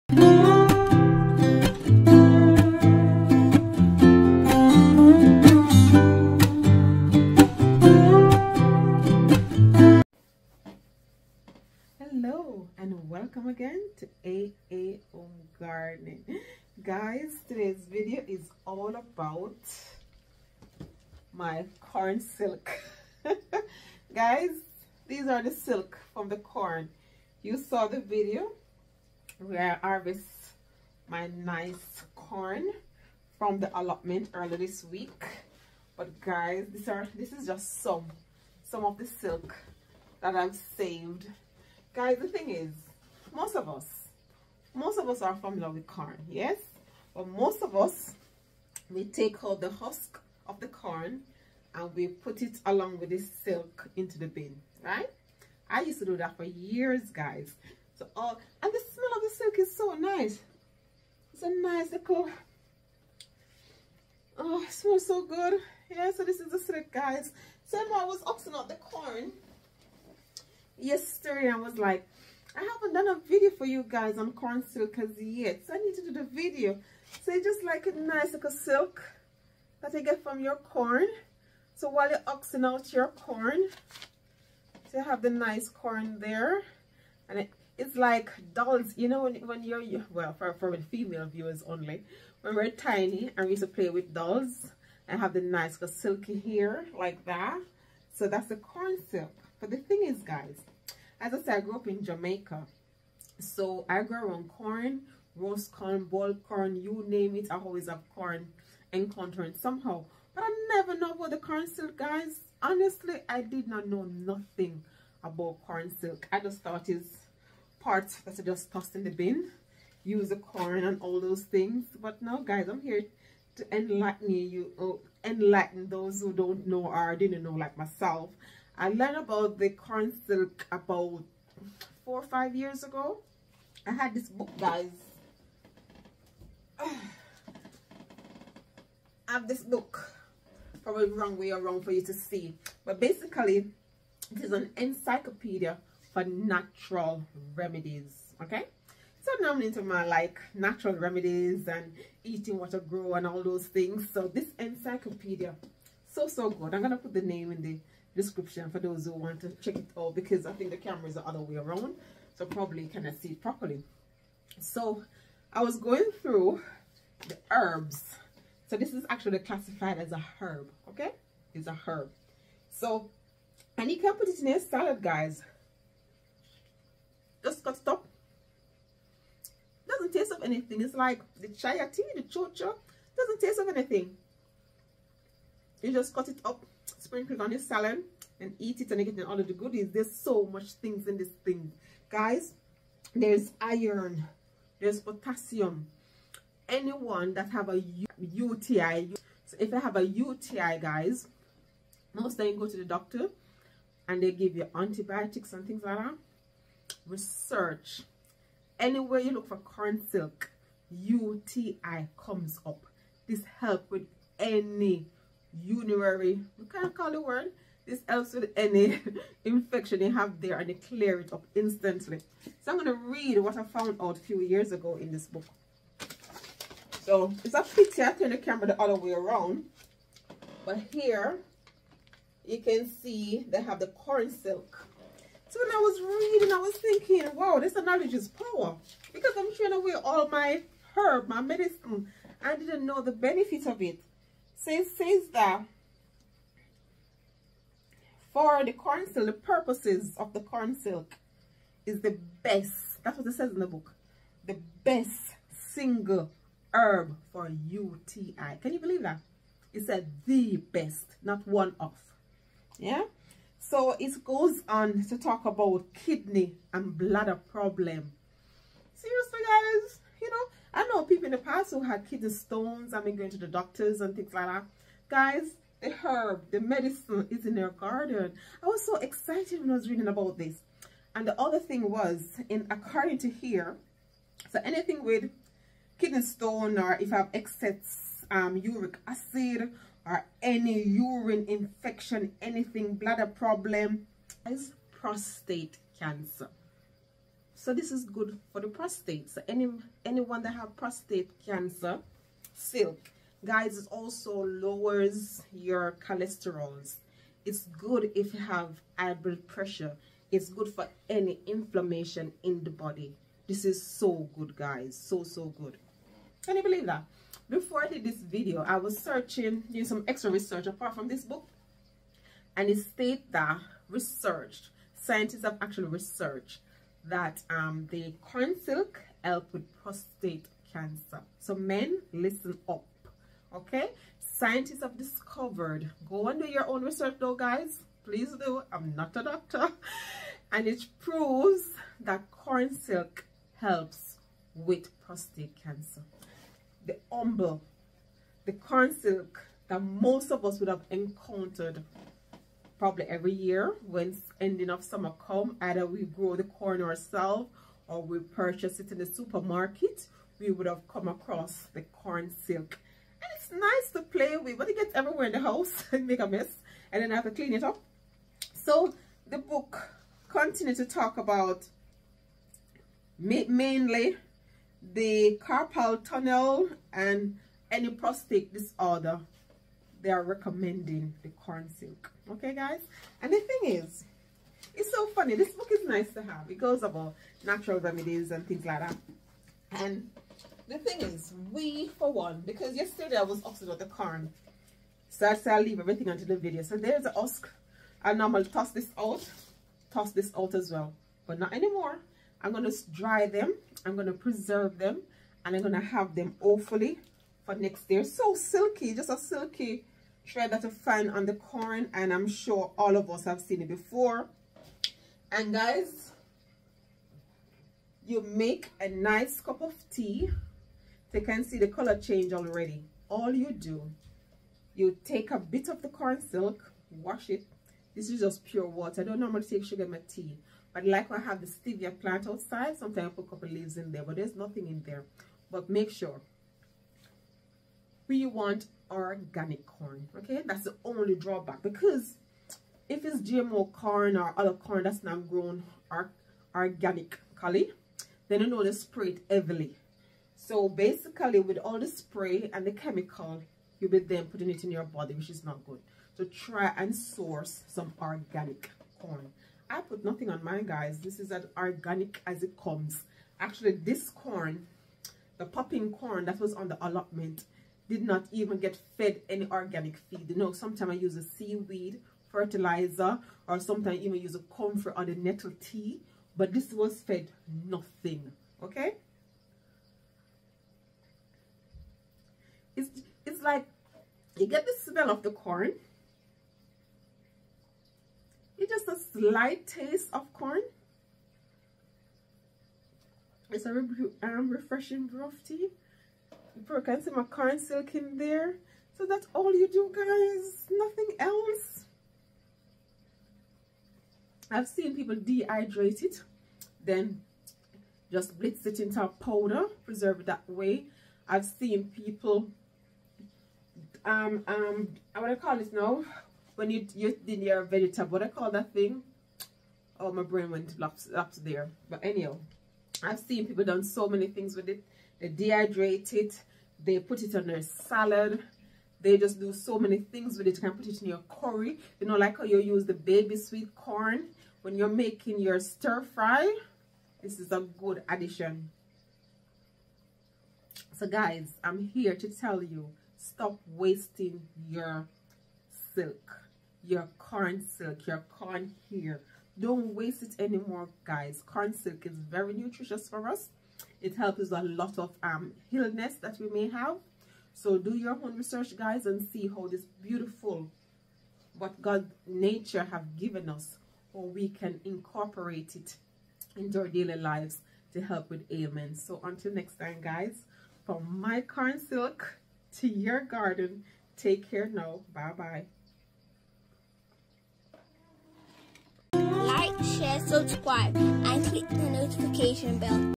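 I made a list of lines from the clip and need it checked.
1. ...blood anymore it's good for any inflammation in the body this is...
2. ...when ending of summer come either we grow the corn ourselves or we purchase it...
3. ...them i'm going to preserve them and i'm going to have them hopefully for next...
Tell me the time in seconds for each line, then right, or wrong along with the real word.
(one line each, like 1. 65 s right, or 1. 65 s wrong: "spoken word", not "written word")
1. 309 s wrong: "pressure", not "anymore"
2. 353 s right
3. 403 s right.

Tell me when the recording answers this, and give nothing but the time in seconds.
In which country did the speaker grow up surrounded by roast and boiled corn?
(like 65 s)
102 s.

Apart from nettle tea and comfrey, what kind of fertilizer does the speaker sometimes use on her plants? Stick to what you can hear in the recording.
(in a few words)
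Seaweed fertilizer.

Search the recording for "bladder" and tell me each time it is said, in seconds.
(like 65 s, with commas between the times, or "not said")
266 s, 292 s.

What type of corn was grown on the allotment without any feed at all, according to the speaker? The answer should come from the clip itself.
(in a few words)
Popping corn.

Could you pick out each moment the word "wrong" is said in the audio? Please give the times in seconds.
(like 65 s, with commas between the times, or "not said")
141 s.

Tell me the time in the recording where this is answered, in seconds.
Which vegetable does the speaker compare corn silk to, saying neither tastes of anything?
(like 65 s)
182 s.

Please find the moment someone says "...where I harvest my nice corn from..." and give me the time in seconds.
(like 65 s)
29 s.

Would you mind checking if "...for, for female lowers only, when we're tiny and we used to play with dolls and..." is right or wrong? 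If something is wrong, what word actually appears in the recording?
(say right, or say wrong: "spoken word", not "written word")
wrong: "viewers", not "lowers".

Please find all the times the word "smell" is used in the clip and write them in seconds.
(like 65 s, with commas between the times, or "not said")
58 s, 64 s, 484 s.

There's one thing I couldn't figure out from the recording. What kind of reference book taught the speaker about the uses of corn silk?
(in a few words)
Encyclopedia for natural remedies.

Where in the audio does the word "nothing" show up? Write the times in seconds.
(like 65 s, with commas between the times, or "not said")
114 s, 434 s, 460 s, 477 s, 500 s.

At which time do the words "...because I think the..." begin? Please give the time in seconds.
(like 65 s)
160 s.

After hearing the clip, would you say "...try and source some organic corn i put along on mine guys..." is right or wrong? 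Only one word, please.
wrong.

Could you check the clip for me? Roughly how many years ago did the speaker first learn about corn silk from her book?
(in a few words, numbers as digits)
4 or 5 years.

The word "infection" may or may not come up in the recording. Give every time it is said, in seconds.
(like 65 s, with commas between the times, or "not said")
219 s, 291 s.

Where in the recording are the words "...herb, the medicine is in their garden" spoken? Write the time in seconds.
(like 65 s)
275 s.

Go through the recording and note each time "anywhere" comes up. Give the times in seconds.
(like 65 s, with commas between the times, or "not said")
208 s.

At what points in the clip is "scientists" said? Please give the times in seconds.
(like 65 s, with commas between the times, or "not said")
324 s, 334 s.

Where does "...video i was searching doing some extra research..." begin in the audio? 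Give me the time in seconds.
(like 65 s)
318 s.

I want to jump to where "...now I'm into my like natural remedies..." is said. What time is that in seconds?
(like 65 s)
149 s.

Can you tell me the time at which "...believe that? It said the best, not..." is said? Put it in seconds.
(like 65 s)
258 s.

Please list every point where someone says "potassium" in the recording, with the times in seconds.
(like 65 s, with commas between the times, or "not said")
194 s.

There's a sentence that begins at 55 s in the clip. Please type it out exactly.
I used to do that for years, guys.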